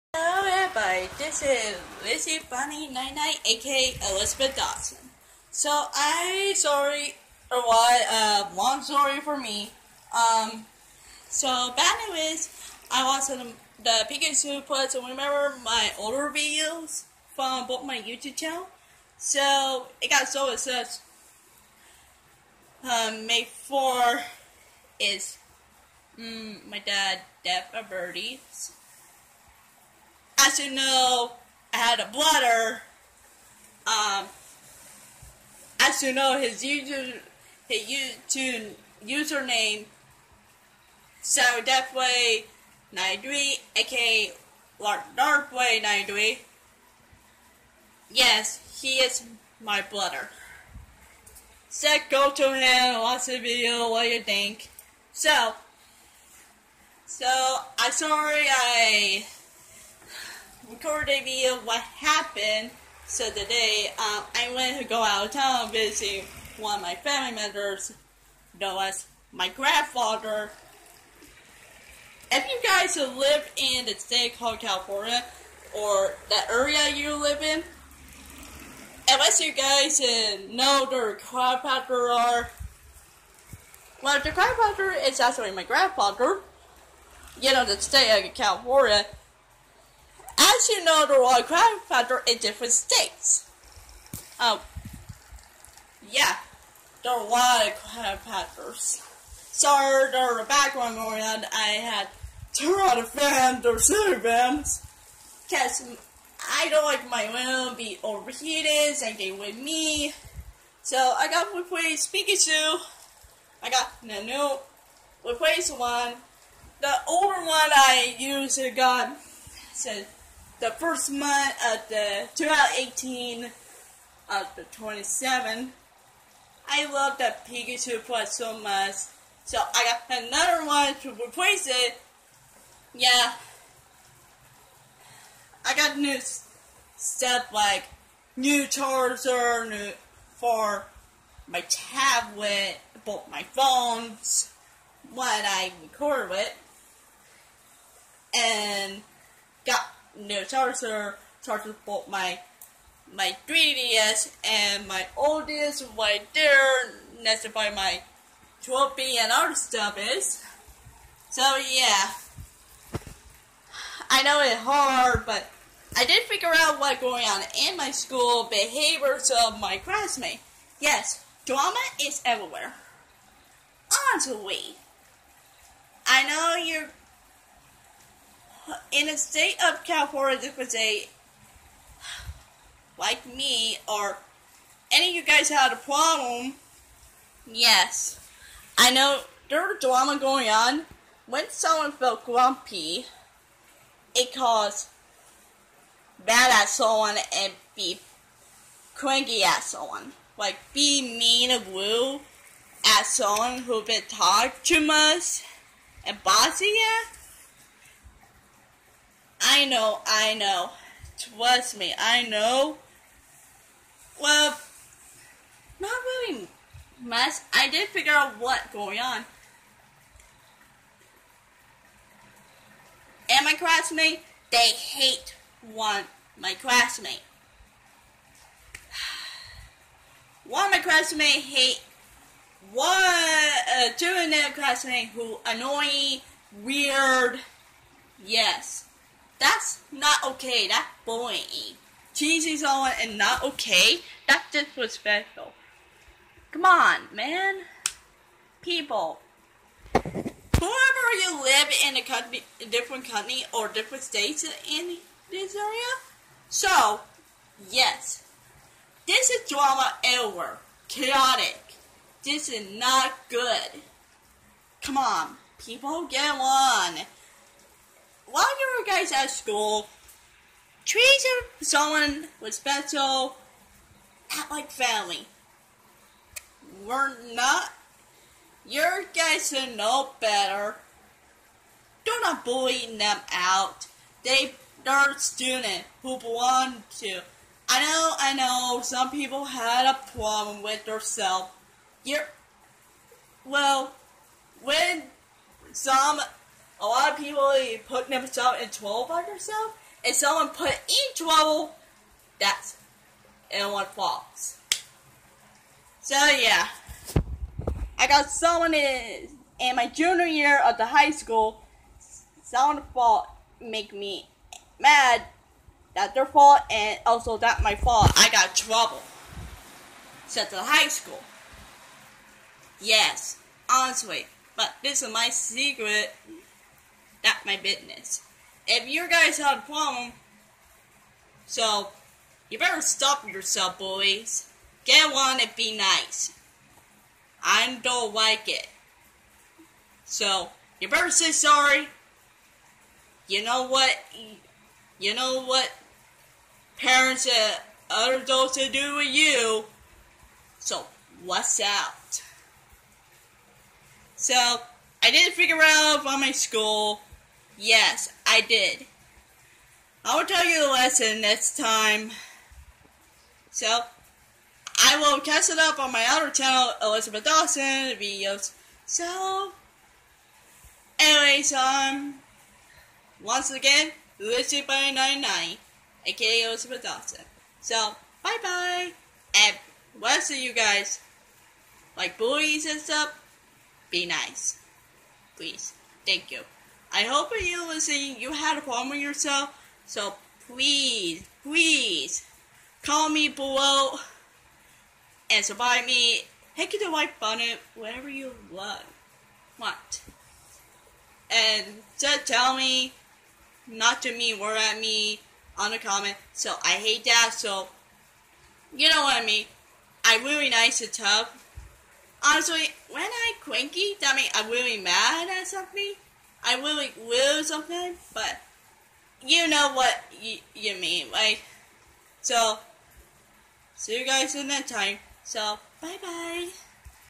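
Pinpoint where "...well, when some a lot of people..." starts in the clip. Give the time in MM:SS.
04:53.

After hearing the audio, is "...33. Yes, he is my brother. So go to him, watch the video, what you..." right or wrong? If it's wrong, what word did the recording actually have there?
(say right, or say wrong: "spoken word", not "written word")
wrong: "93", not "33".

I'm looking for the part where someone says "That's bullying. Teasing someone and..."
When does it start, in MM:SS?
04:00.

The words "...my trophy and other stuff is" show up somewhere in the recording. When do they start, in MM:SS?
02:37.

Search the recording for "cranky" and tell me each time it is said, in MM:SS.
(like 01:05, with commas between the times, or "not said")
03:18, 06:53.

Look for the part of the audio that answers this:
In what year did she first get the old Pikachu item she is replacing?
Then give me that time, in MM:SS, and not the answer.
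02:02.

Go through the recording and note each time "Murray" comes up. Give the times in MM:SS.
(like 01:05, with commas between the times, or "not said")
not said.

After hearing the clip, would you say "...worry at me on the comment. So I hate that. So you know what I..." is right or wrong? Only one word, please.
right.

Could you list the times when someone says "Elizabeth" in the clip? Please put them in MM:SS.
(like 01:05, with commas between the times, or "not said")
00:04, 06:06, 06:16.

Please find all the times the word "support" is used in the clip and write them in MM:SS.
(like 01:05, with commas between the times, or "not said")
06:35.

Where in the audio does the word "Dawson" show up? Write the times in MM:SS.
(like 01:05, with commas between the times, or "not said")
00:04, 06:07, 06:16.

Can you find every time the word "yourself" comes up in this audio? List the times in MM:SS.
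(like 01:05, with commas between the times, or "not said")
05:33, 06:28.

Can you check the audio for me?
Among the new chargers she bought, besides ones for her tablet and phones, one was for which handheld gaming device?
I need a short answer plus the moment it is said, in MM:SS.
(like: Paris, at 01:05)
3DS, at 02:33.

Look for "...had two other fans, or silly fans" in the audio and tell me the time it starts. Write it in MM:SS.
01:41.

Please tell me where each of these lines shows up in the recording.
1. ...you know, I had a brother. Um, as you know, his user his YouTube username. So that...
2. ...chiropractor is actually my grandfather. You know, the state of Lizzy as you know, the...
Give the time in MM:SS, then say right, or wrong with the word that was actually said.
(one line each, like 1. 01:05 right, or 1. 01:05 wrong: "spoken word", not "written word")
1. 00:30 right
2. 01:24 wrong: "California", not "Lizzy".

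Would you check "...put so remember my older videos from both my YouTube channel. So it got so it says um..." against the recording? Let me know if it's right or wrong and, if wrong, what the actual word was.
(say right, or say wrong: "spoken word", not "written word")
right.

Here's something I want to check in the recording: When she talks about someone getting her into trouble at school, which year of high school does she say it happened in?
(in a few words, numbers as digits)
Junior year.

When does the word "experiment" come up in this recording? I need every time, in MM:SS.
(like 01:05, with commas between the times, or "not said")
not said.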